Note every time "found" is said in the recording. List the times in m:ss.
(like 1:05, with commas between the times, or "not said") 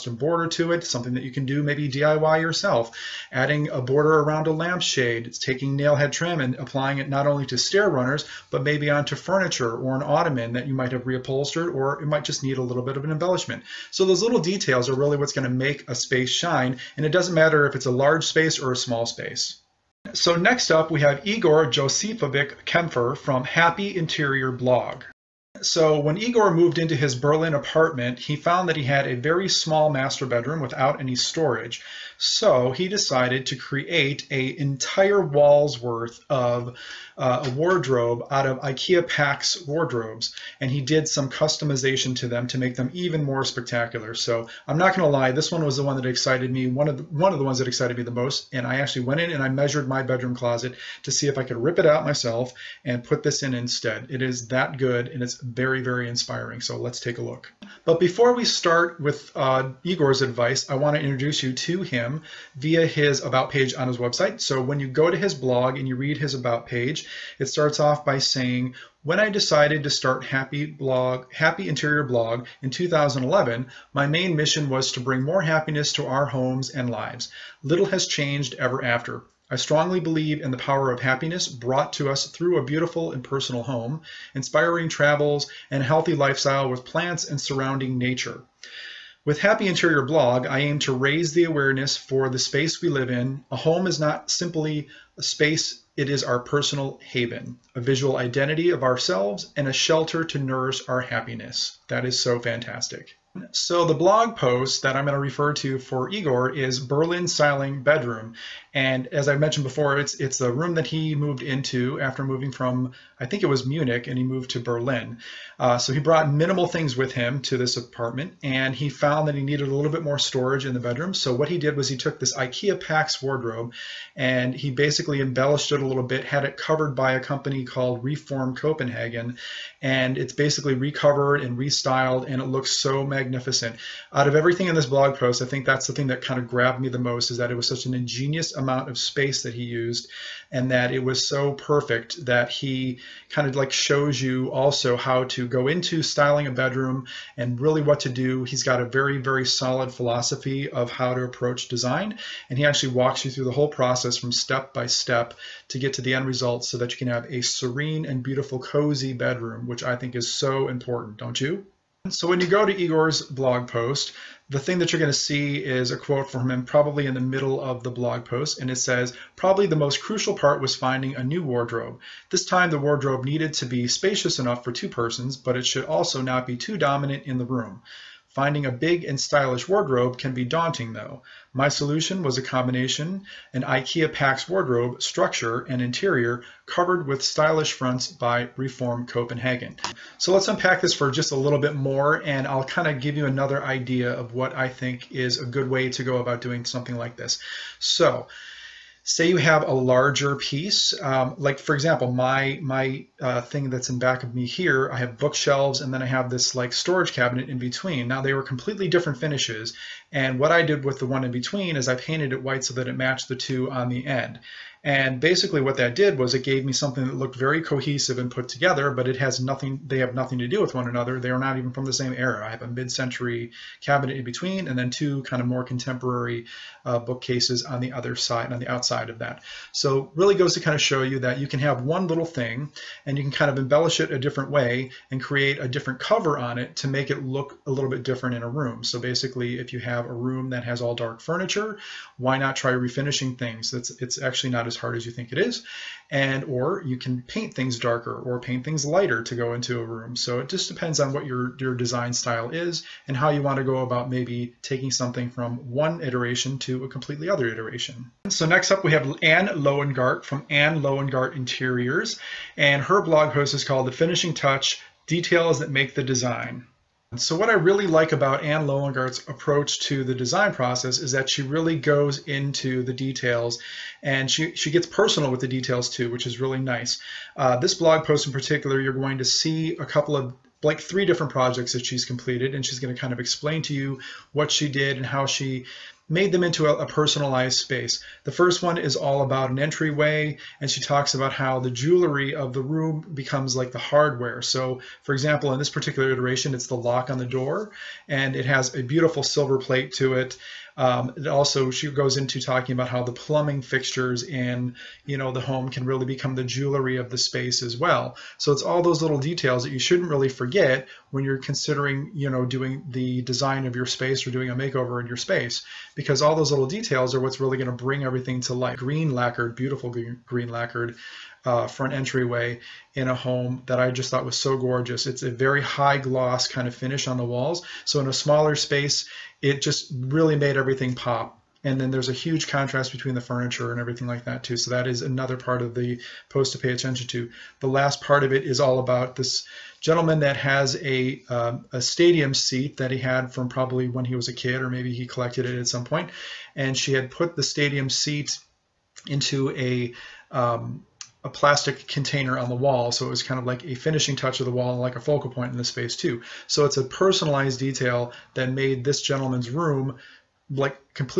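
0:28, 1:58.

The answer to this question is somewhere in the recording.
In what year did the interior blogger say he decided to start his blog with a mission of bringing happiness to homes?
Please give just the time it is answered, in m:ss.
1:12.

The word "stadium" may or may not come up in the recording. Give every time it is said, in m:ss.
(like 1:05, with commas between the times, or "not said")
5:41, 5:47.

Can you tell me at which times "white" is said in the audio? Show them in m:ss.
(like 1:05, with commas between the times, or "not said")
3:32.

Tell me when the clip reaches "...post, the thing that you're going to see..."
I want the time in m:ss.
2:43.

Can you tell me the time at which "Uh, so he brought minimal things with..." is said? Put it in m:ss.
1:55.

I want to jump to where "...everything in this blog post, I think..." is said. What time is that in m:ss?
2:14.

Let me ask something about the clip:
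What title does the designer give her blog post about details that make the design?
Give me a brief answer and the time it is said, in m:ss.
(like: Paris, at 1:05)
The Finishing Touch, at 4:23.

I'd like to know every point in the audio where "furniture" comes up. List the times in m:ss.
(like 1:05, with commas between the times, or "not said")
0:09, 4:01, 5:33.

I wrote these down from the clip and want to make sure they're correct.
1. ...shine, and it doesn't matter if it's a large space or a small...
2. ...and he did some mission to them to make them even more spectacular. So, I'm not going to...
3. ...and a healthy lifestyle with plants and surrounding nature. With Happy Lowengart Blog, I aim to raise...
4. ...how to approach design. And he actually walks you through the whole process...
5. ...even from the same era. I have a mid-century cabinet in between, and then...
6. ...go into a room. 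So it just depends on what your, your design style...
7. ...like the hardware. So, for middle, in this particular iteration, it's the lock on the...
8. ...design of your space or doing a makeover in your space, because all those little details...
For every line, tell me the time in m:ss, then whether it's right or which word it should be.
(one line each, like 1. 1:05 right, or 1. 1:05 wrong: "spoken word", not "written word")
1. 0:16 right
2. 0:40 wrong: "customization", not "mission"
3. 1:25 wrong: "Interior", not "Lowengart"
4. 2:30 right
5. 3:41 right
6. 4:09 right
7. 4:53 wrong: "example", not "middle"
8. 5:13 right.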